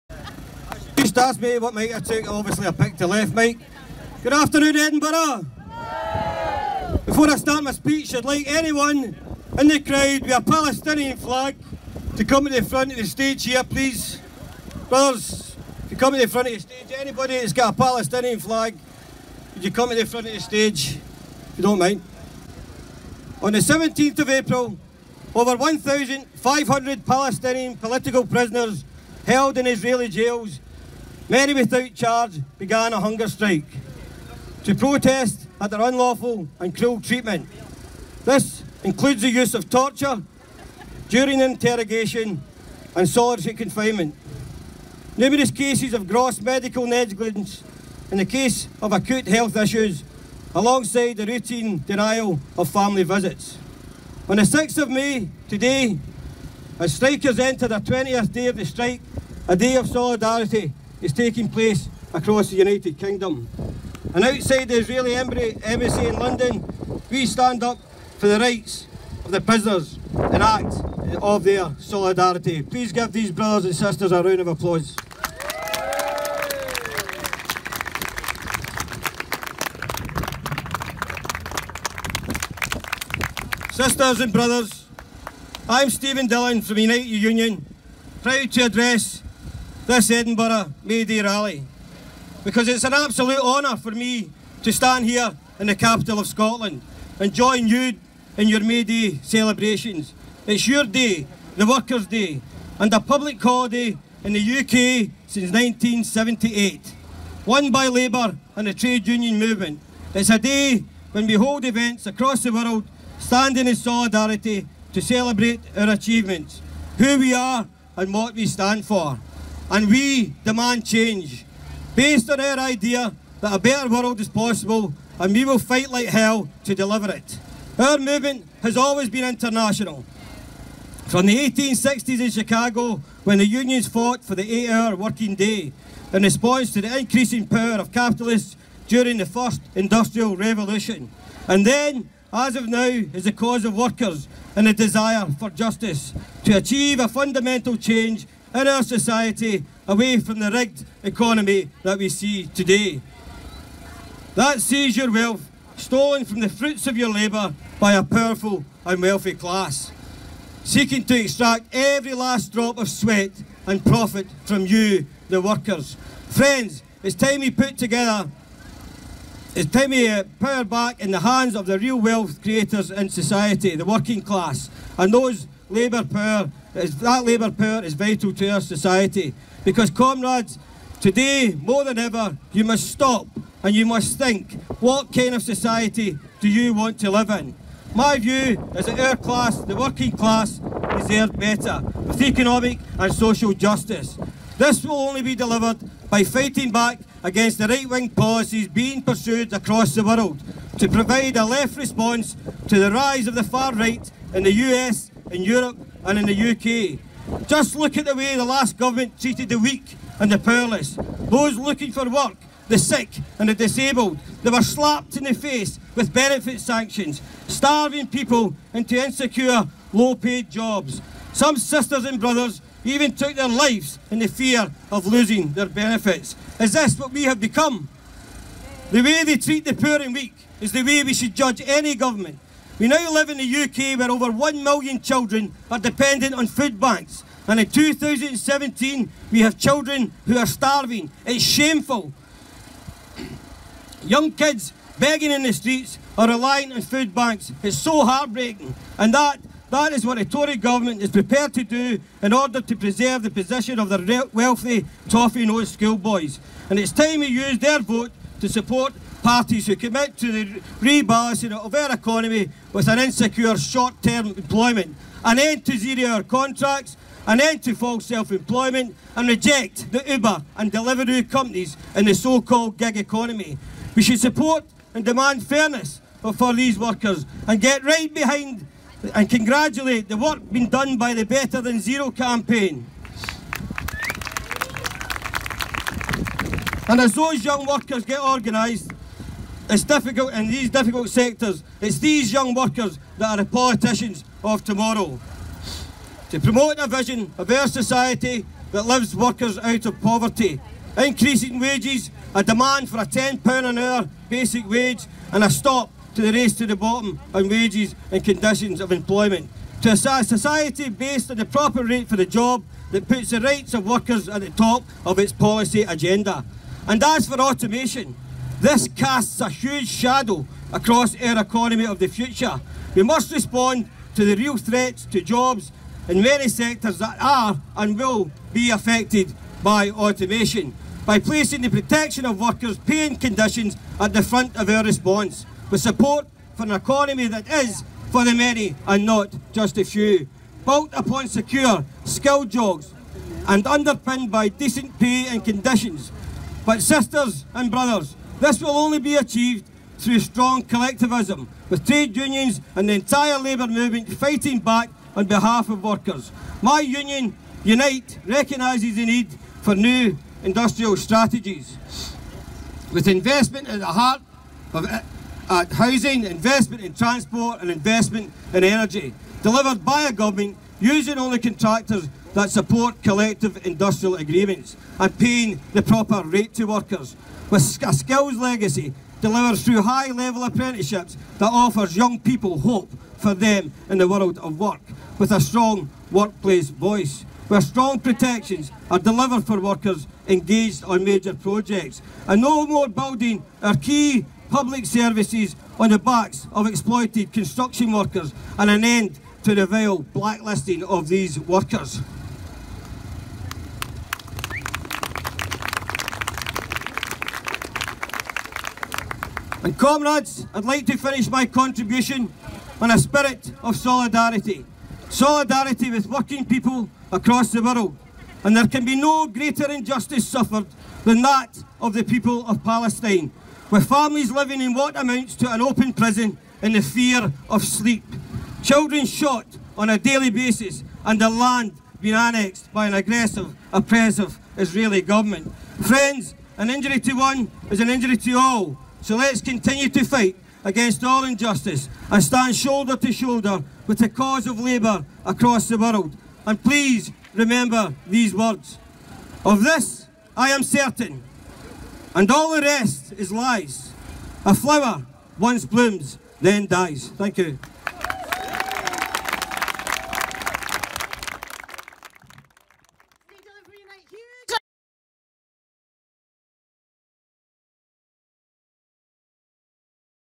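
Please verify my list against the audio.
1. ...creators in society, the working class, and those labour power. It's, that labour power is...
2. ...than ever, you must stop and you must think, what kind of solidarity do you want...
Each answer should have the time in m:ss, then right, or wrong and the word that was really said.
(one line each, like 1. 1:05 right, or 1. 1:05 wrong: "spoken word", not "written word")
1. 2:52 right
2. 3:01 wrong: "society", not "solidarity".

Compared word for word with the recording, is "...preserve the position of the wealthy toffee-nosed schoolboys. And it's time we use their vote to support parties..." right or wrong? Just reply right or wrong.
right.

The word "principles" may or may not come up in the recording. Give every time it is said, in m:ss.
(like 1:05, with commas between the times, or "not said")
not said.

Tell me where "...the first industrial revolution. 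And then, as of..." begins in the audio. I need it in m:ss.
2:19.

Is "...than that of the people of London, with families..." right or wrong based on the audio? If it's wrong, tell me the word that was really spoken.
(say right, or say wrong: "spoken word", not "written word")
wrong: "Palestine", not "London".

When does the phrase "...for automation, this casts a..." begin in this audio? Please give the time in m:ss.
5:17.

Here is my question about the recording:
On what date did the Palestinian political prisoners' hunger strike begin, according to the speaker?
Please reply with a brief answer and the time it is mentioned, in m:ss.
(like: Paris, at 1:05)
17th of April, at 0:23.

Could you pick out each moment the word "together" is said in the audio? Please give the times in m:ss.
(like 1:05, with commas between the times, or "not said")
2:47.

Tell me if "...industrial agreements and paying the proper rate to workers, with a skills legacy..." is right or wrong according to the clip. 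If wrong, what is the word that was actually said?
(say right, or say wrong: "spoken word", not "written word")
right.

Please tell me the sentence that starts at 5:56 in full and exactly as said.
My union, Unite, recognises the need for new industrial strategies.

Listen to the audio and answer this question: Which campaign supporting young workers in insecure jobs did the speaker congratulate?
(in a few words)
Better Than Zero.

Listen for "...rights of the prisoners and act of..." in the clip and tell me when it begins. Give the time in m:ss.
1:08.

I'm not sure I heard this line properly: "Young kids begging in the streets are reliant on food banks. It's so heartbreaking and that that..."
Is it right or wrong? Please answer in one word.
right.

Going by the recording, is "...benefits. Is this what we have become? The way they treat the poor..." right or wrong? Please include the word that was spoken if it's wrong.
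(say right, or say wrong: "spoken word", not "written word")
right.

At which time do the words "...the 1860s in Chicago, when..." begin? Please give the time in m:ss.
2:11.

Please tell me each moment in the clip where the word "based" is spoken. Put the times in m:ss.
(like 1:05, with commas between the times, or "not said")
2:01, 5:10.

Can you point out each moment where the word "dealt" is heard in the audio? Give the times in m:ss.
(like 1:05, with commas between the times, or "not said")
not said.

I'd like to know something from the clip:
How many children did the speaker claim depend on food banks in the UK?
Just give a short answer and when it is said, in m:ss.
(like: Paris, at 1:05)
over 1 million, at 3:54.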